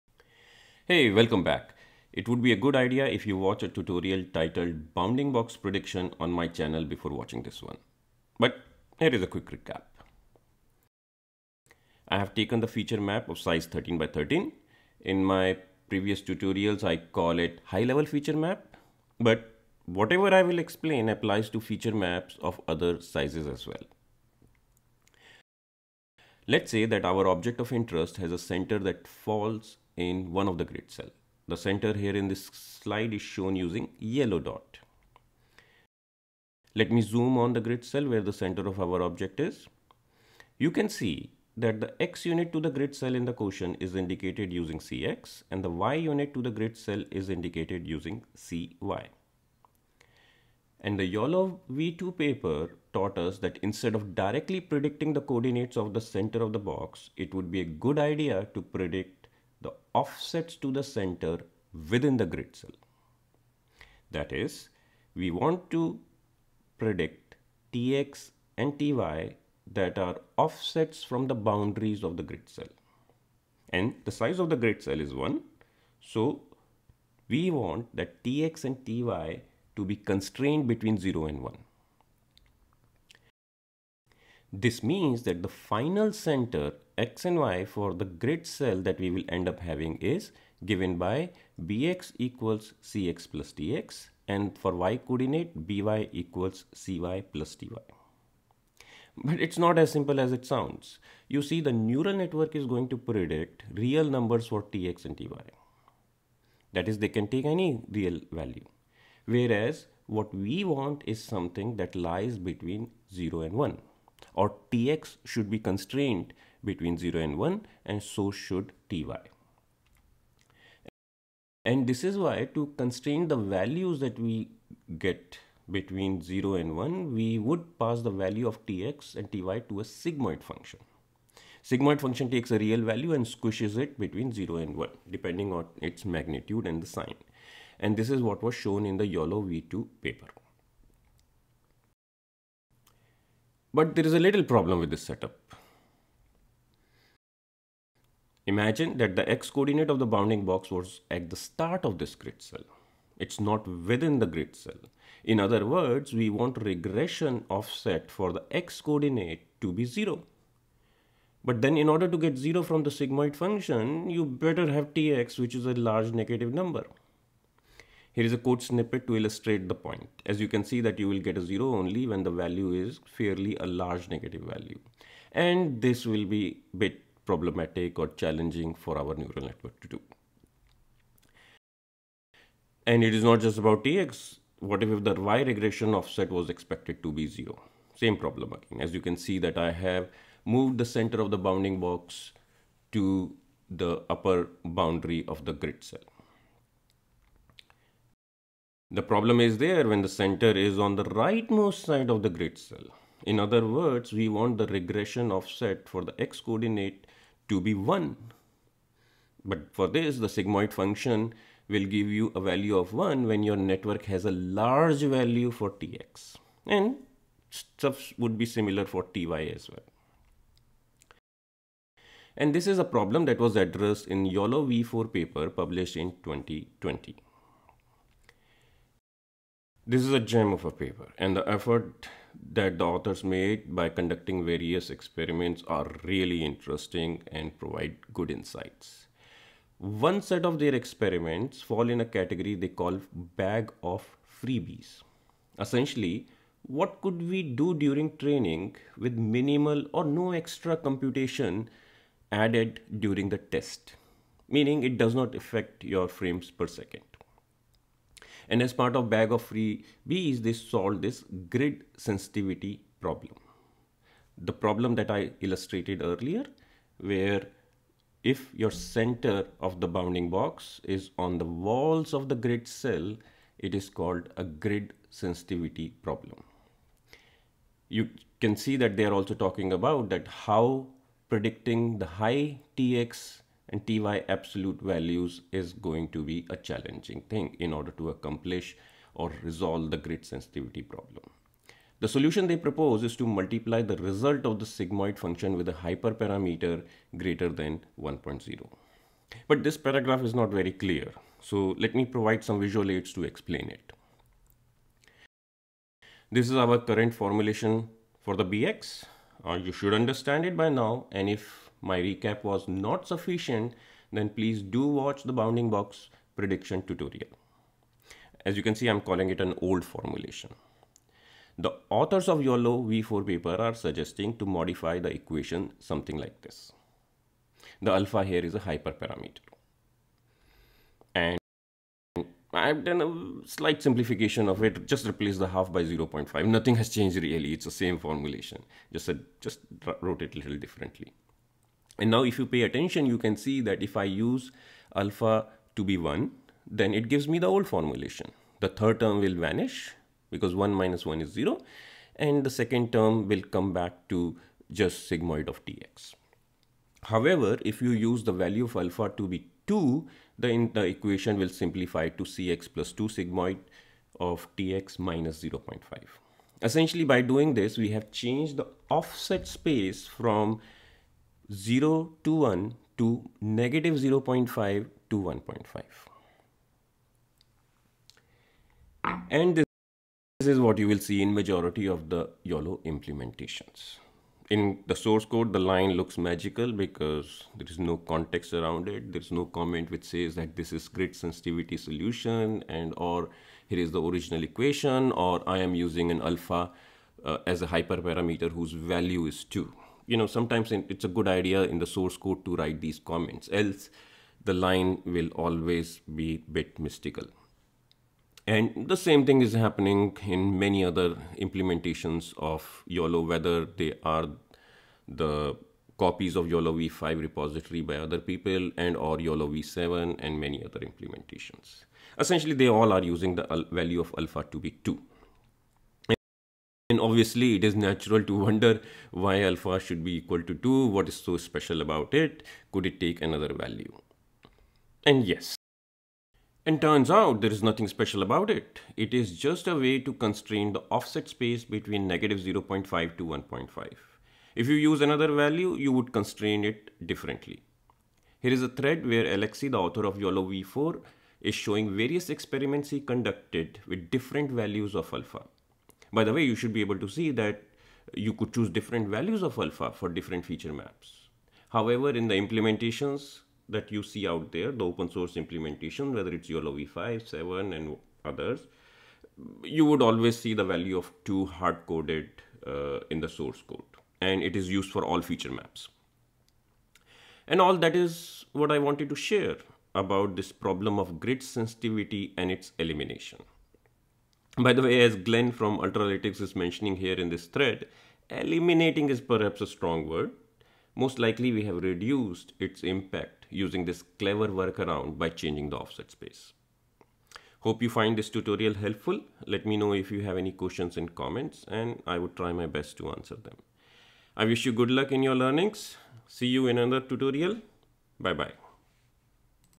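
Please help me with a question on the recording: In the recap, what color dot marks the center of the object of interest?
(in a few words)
Yellow.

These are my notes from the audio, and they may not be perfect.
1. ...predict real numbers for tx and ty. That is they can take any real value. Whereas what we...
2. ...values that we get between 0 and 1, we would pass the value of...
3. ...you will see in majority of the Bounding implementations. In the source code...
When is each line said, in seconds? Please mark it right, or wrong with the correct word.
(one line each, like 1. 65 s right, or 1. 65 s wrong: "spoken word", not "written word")
1. 102 s right
2. 123 s right
3. 380 s wrong: "YOLO", not "Bounding".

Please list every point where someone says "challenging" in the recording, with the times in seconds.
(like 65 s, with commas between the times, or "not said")
178 s, 286 s.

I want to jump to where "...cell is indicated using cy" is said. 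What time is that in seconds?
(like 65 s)
46 s.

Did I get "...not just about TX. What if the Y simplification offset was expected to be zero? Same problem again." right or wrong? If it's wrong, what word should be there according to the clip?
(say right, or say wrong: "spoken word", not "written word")
wrong: "regression", not "simplification".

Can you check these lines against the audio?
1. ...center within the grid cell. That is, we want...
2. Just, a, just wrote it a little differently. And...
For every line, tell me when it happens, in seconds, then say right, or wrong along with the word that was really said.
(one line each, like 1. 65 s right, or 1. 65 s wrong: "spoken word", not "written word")
1. 60 s right
2. 338 s right.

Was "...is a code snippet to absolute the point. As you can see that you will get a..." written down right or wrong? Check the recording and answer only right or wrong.
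wrong.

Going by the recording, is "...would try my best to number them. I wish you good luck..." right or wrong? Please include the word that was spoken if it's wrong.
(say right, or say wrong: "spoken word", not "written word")
wrong: "answer", not "number".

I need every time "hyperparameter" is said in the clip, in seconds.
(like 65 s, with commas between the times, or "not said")
295 s, 328 s, 397 s.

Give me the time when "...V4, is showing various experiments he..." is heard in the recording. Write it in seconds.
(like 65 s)
450 s.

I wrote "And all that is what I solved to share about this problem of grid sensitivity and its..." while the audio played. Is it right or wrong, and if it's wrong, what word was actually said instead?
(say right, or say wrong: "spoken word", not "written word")
wrong: "wanted", not "solved".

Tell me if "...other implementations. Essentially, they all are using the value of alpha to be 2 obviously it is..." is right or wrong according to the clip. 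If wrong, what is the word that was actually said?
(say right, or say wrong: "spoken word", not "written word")
right.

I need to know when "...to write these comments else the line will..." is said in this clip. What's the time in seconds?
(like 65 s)
402 s.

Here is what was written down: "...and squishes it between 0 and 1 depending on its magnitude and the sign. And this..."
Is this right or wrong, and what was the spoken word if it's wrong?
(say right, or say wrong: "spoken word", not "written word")
right.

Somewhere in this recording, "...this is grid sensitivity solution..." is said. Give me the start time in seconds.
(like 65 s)
390 s.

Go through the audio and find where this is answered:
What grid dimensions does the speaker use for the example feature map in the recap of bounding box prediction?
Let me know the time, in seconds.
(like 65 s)
13 s.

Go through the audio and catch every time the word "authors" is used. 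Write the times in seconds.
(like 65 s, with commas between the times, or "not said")
232 s, 321 s, 449 s.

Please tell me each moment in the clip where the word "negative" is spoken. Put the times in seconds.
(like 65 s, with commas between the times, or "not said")
166 s, 174 s, 373 s, 442 s.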